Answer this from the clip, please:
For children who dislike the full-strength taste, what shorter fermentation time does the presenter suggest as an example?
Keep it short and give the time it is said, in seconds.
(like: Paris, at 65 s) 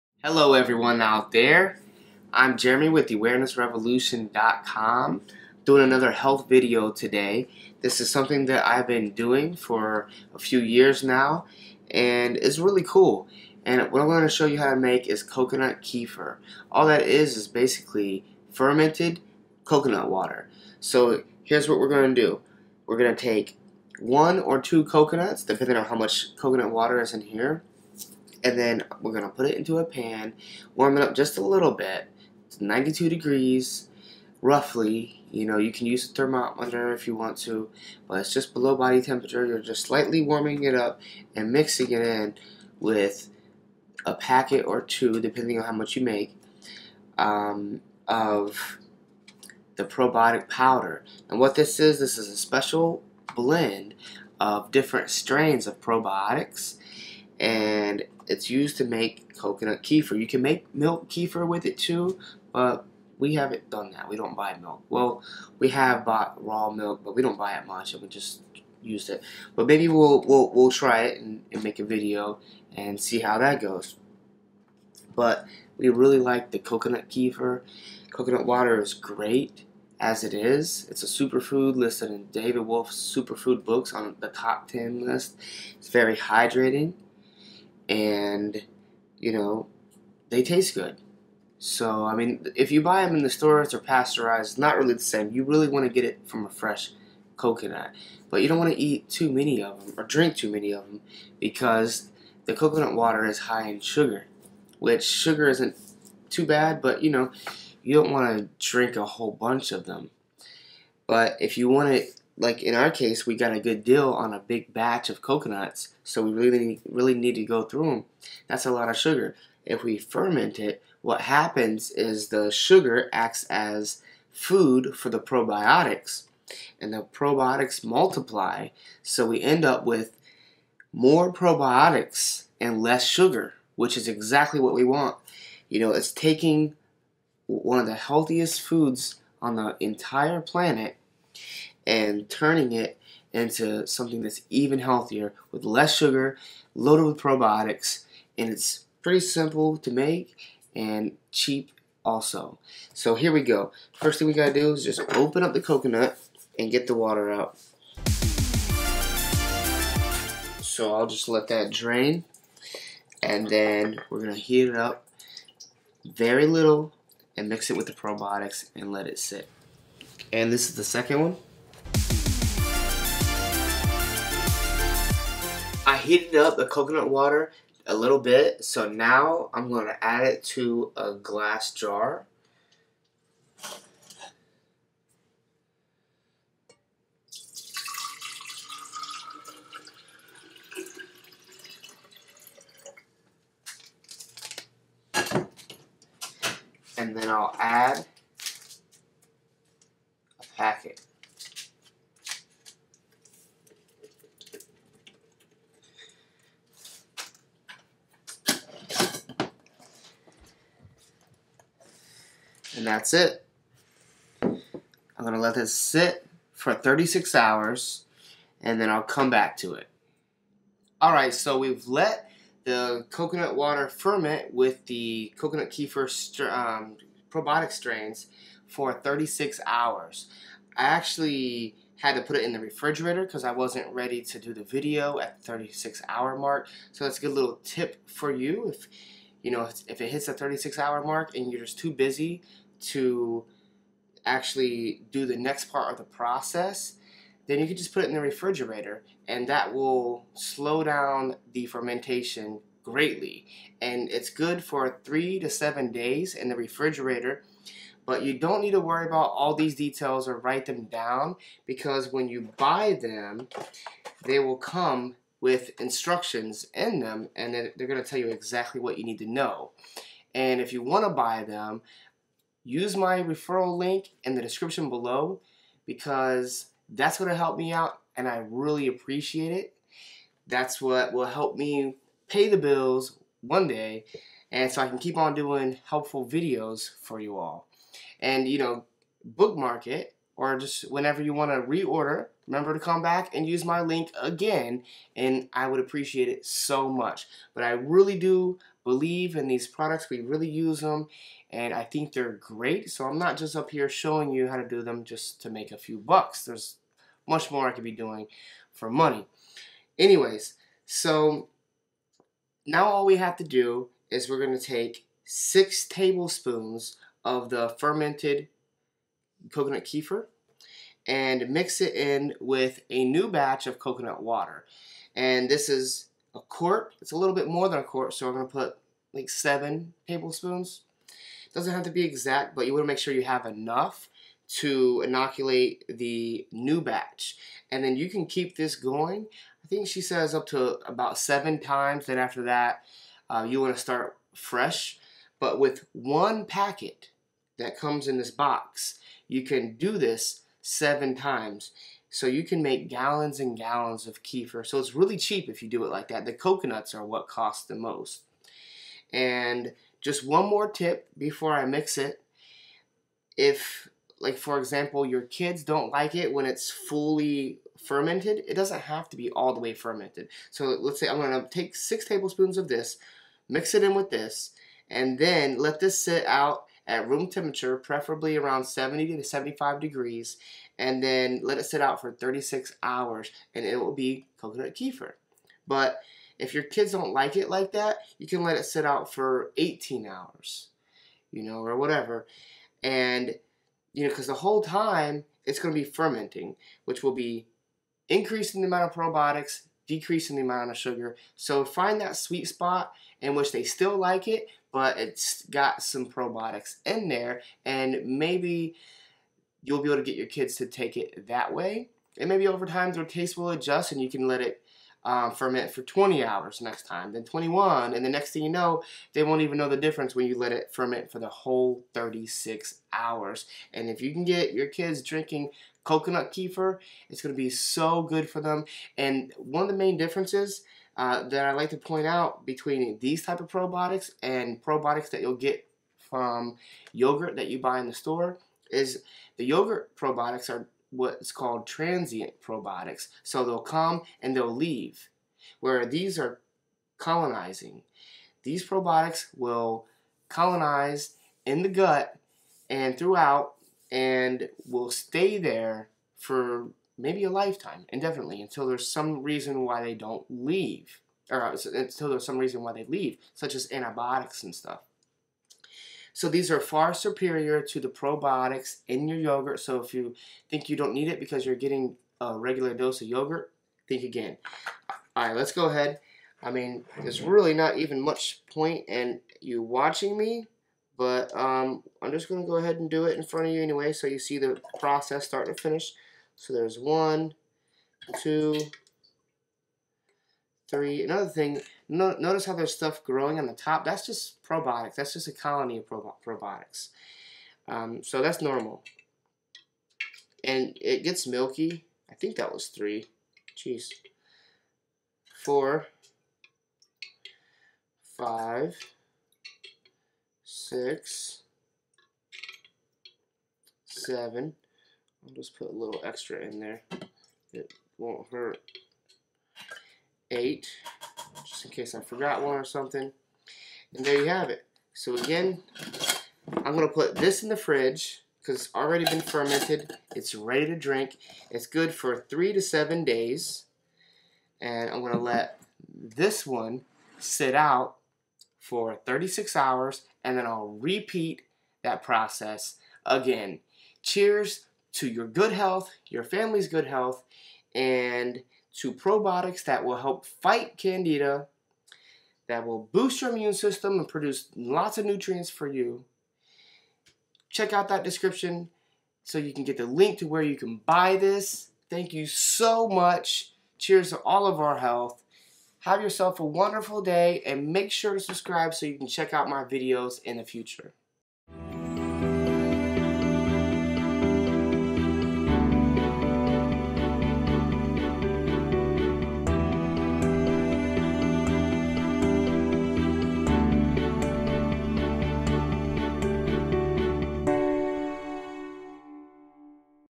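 18 hours, at 389 s.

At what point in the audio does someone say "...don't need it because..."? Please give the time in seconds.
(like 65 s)
470 s.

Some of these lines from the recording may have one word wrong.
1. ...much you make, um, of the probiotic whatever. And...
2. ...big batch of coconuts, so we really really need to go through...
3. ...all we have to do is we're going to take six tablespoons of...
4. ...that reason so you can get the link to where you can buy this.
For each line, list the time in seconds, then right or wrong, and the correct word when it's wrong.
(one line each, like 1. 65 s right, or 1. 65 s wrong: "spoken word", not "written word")
1. 45 s wrong: "powder", not "whatever"
2. 114 s right
3. 312 s right
4. 557 s wrong: "description", not "reason".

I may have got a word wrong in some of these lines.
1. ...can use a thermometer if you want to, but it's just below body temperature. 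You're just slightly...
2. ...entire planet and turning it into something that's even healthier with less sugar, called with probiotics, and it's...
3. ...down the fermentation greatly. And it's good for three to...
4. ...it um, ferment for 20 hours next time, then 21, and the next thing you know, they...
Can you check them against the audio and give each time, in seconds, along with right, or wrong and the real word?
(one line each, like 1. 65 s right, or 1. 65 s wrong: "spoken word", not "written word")
1. 35 s right
2. 139 s wrong: "loaded", not "called"
3. 250 s right
4. 414 s right.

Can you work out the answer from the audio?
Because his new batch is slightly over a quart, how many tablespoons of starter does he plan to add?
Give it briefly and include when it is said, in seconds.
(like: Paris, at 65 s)
7 tablespoons, at 329 s.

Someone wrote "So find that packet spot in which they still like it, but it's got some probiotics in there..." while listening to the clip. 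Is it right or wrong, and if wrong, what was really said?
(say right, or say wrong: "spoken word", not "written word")
wrong: "sweet", not "packet".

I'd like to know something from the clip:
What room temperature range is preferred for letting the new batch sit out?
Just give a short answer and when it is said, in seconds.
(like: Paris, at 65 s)
70 to 75 degrees, at 378 s.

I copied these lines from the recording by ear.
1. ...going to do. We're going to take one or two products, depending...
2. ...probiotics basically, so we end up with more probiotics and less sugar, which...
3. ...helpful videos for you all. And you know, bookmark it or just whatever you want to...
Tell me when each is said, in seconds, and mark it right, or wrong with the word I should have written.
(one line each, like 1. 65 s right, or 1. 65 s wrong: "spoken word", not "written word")
1. 21 s wrong: "coconuts", not "products"
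2. 127 s wrong: "multiply", not "basically"
3. 285 s wrong: "whenever", not "whatever".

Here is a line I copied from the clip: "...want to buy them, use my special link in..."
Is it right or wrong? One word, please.
wrong.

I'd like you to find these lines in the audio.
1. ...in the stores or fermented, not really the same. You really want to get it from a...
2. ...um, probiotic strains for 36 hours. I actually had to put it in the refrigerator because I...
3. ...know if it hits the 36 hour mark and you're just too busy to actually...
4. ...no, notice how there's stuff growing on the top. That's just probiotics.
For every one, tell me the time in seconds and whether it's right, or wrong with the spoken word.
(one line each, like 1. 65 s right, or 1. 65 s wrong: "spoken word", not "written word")
1. 93 s wrong: "pasteurized", not "fermented"
2. 226 s right
3. 239 s right
4. 491 s right.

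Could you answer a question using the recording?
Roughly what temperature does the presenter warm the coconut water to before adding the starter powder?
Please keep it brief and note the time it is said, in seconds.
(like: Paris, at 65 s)
92 degrees, at 32 s.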